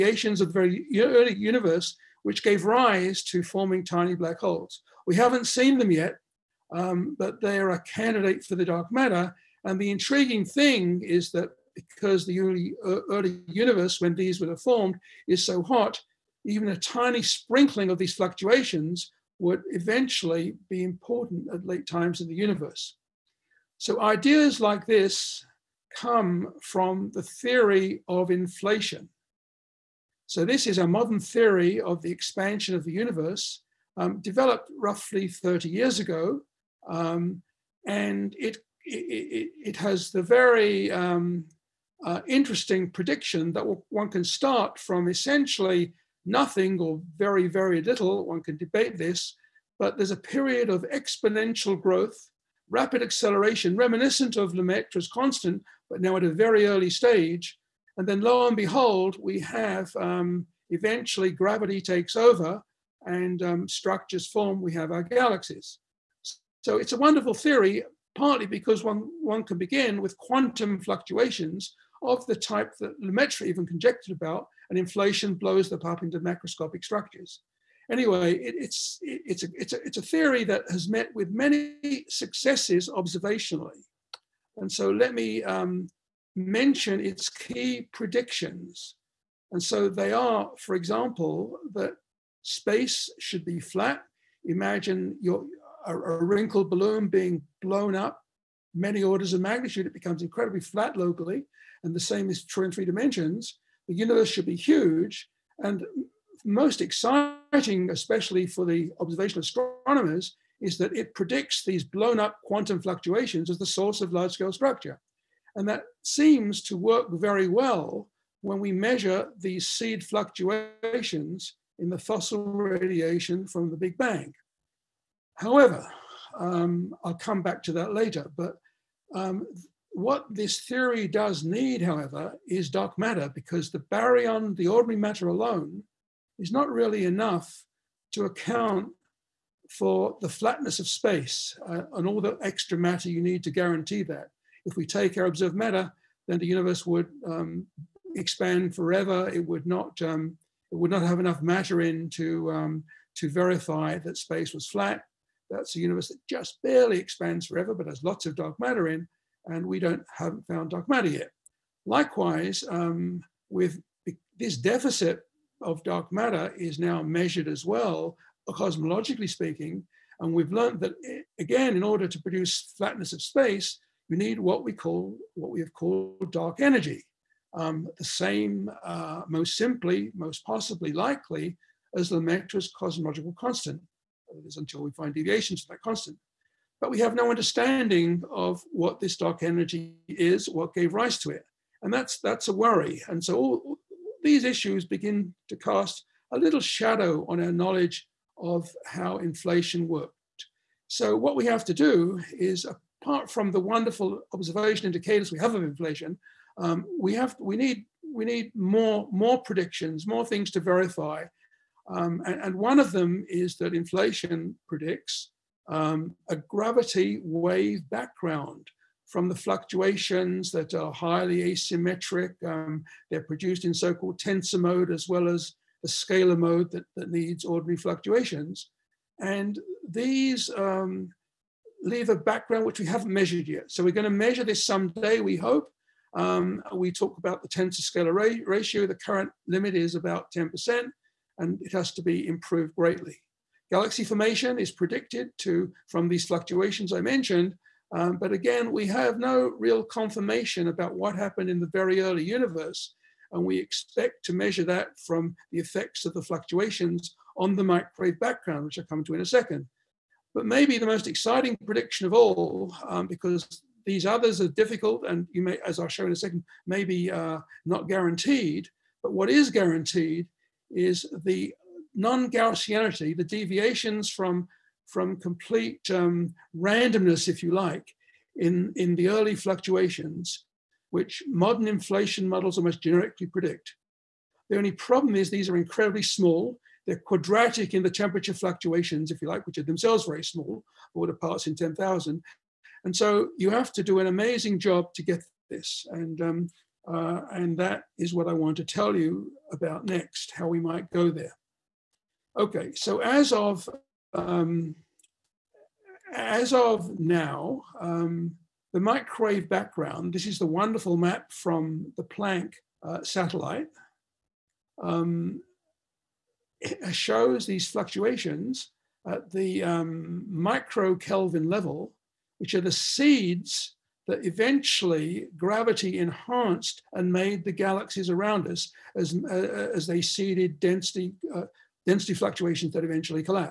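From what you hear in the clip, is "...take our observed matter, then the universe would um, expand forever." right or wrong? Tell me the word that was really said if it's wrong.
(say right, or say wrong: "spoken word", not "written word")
right.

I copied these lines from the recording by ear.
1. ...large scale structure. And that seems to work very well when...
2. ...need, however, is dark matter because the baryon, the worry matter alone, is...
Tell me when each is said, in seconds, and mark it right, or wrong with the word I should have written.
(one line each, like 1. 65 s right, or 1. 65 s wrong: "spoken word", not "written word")
1. 114 s right
2. 131 s wrong: "ordinary", not "worry".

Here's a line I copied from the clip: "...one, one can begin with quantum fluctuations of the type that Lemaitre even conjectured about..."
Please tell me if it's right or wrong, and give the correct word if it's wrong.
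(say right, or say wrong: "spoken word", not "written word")
right.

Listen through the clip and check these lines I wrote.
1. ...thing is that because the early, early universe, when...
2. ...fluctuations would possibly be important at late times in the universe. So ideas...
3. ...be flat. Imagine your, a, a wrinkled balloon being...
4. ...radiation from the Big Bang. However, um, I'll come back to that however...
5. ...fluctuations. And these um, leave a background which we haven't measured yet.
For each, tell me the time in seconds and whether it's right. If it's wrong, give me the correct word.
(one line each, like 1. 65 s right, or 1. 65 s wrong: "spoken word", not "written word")
1. 10 s right
2. 18 s wrong: "eventually", not "possibly"
3. 93 s right
4. 122 s wrong: "later", not "however"
5. 227 s right.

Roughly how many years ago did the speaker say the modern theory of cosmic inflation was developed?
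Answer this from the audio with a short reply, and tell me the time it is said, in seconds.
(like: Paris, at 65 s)
30 years, at 35 s.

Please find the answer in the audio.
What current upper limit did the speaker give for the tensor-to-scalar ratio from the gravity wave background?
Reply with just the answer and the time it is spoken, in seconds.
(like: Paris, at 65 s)
10%, at 240 s.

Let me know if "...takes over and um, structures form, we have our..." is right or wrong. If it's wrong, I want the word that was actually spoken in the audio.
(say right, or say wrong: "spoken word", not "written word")
right.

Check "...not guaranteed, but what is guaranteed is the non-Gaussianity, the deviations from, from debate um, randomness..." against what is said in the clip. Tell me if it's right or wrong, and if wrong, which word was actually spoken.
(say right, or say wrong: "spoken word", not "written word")
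wrong: "complete", not "debate".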